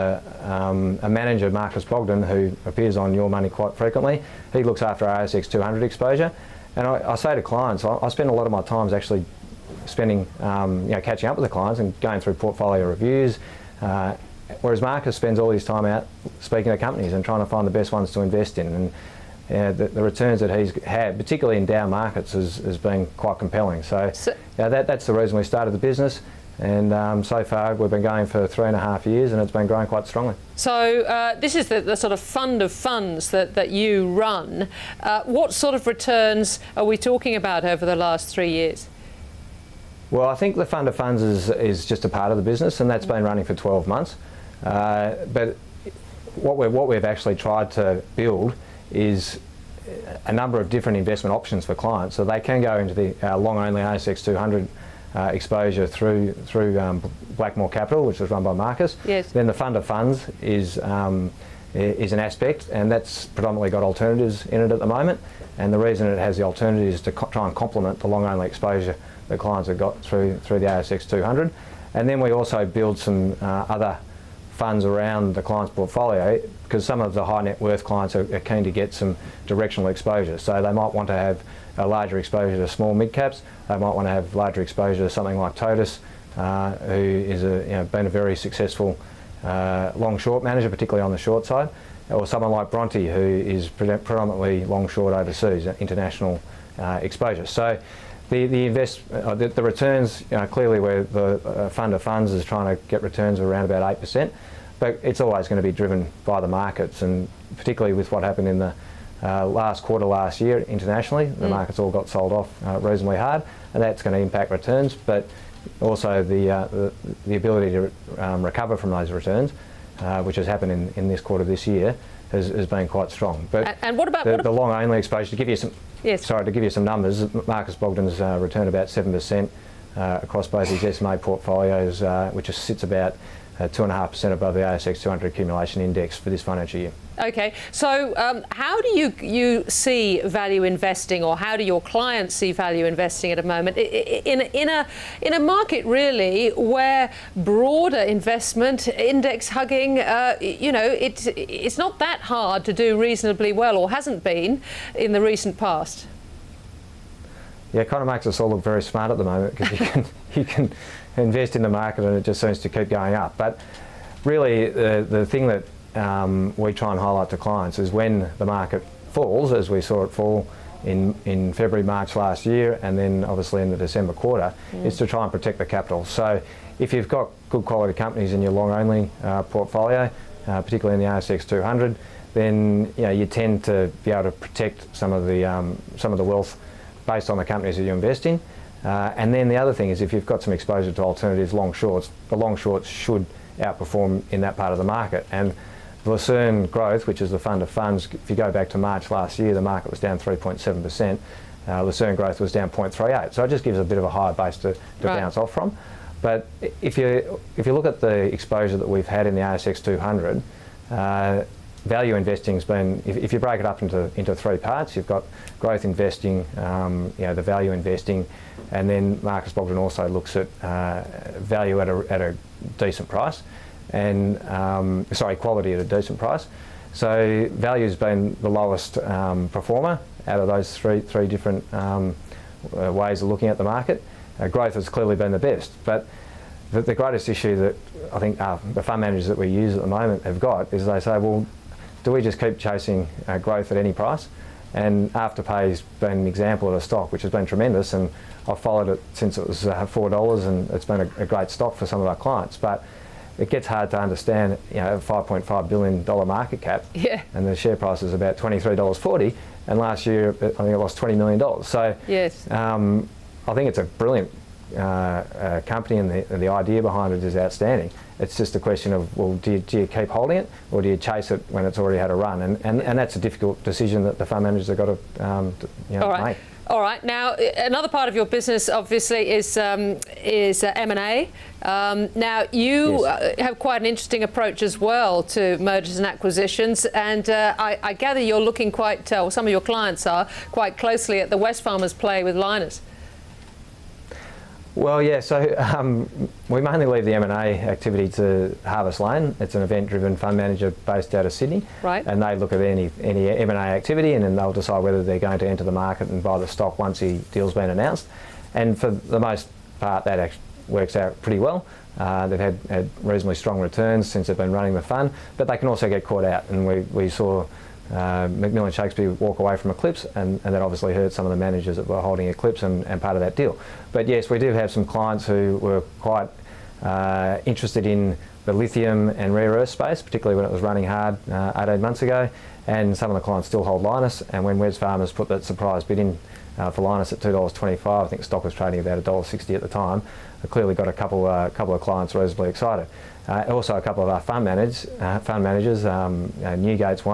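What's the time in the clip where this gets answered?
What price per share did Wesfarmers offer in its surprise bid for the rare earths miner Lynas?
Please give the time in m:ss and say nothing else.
5:37.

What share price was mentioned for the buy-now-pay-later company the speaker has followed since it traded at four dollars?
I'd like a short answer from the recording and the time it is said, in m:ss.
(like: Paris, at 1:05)
$23.40, at 4:18.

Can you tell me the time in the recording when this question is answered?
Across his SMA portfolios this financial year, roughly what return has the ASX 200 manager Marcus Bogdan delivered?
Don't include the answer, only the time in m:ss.
2:08.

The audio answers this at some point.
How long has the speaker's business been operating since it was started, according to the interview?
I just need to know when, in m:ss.
0:28.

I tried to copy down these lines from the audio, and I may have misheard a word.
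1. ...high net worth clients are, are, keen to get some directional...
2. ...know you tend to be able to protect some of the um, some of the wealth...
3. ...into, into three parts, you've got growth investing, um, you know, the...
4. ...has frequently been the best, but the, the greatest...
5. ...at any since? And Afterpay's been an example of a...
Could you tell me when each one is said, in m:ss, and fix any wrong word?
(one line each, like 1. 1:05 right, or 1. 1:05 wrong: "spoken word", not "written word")
1. 1:17 right
2. 3:03 right
3. 3:33 right
4. 3:54 wrong: "clearly", not "frequently"
5. 4:03 wrong: "price", not "since".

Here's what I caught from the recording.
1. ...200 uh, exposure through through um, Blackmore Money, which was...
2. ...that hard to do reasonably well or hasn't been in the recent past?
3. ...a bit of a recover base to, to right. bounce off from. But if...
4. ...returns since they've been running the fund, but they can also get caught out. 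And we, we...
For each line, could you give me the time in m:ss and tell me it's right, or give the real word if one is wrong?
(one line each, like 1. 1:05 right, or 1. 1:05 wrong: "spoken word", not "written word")
1. 0:54 wrong: "Capital", not "Money"
2. 2:31 right
3. 3:23 wrong: "higher", not "recover"
4. 5:13 right.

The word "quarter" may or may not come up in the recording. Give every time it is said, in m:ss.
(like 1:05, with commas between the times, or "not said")
1:49, 2:01, 2:54.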